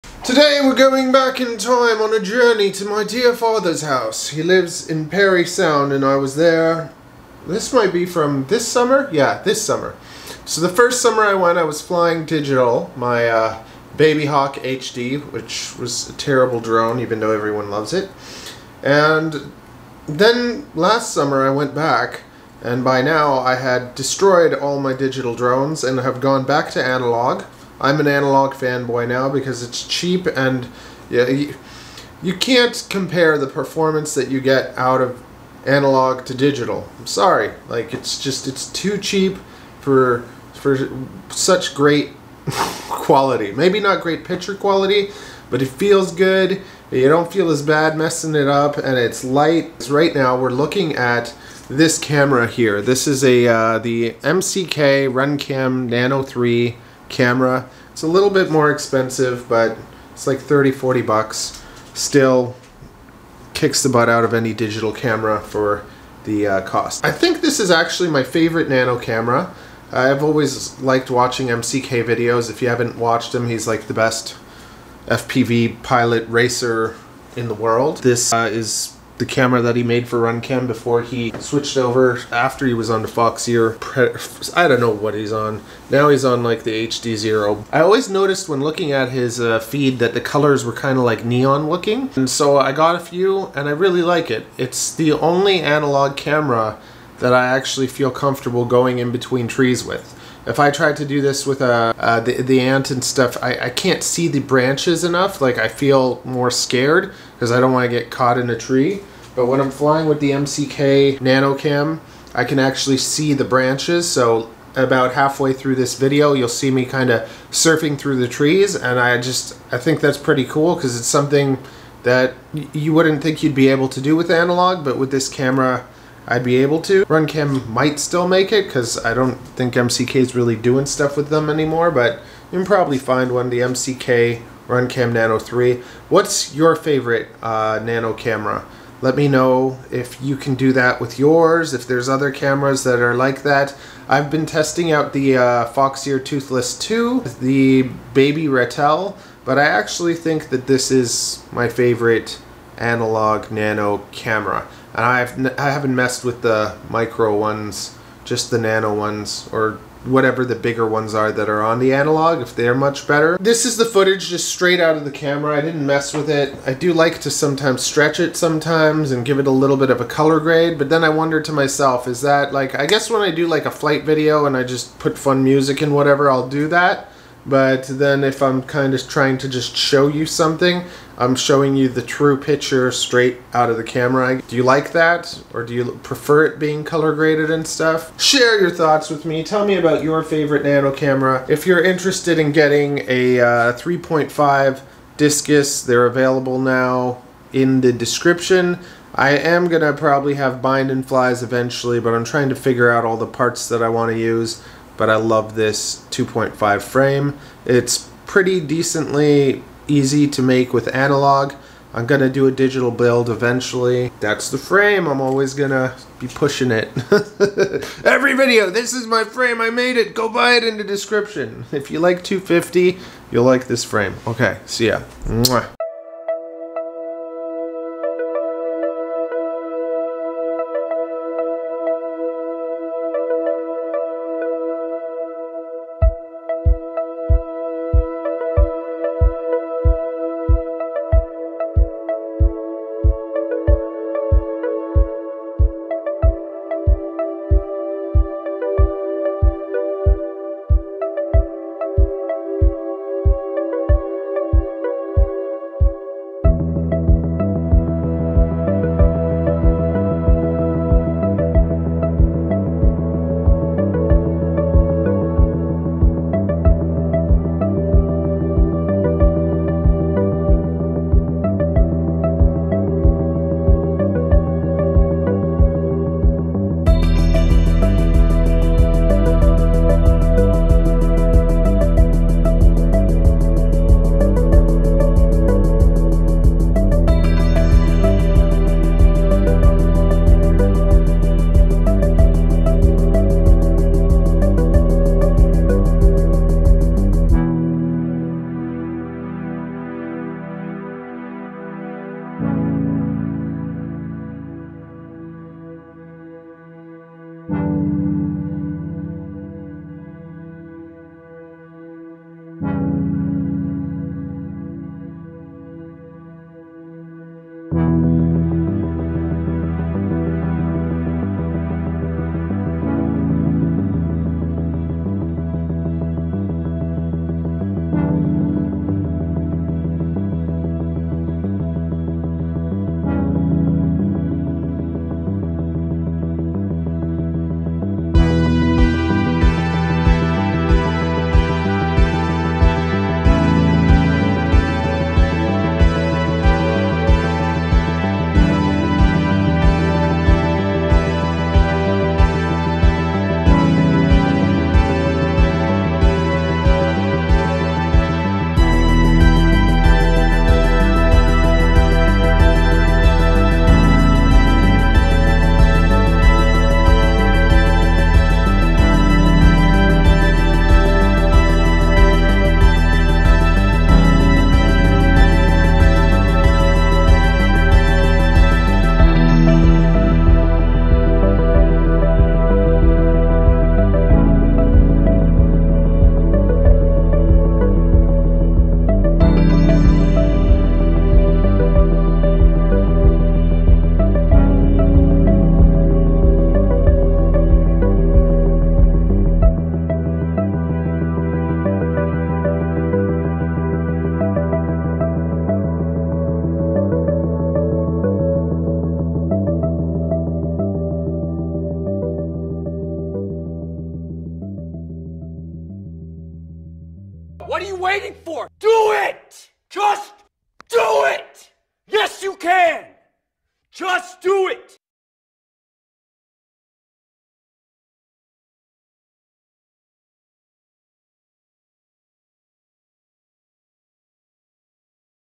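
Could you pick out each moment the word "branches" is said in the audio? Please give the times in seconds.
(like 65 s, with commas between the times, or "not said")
104 s, 113 s.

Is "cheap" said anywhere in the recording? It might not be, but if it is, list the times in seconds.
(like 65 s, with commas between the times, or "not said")
29 s, 38 s.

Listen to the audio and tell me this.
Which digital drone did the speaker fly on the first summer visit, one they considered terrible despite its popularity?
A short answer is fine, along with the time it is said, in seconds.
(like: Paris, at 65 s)
Baby Hawk HD, at 13 s.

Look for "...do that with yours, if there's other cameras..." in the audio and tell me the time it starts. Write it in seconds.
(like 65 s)
140 s.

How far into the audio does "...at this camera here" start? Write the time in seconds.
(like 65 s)
50 s.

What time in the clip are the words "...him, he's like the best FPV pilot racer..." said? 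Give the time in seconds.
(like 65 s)
73 s.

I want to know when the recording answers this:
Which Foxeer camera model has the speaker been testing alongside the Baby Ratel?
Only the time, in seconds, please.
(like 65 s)
146 s.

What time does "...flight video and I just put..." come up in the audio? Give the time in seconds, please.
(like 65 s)
173 s.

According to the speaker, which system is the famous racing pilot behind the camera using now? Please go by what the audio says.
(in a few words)
HDZero.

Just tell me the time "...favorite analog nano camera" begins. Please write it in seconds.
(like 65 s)
151 s.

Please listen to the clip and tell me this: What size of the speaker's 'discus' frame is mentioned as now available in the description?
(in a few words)
3.5.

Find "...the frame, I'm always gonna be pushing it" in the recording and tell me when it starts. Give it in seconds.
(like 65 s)
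214 s.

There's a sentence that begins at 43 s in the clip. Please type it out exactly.
Maybe not great picture quality, but it feels good.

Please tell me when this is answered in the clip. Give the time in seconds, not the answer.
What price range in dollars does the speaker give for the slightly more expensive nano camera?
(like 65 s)
60 s.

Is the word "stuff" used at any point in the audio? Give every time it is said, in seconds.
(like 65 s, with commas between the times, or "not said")
103 s, 130 s, 187 s.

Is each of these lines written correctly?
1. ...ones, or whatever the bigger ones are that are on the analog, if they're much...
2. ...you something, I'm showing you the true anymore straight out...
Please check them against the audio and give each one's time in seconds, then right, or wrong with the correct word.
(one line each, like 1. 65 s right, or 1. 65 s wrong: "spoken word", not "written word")
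1. 158 s right
2. 180 s wrong: "picture", not "anymore".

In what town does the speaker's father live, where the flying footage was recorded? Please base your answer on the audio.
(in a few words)
Parry Sound.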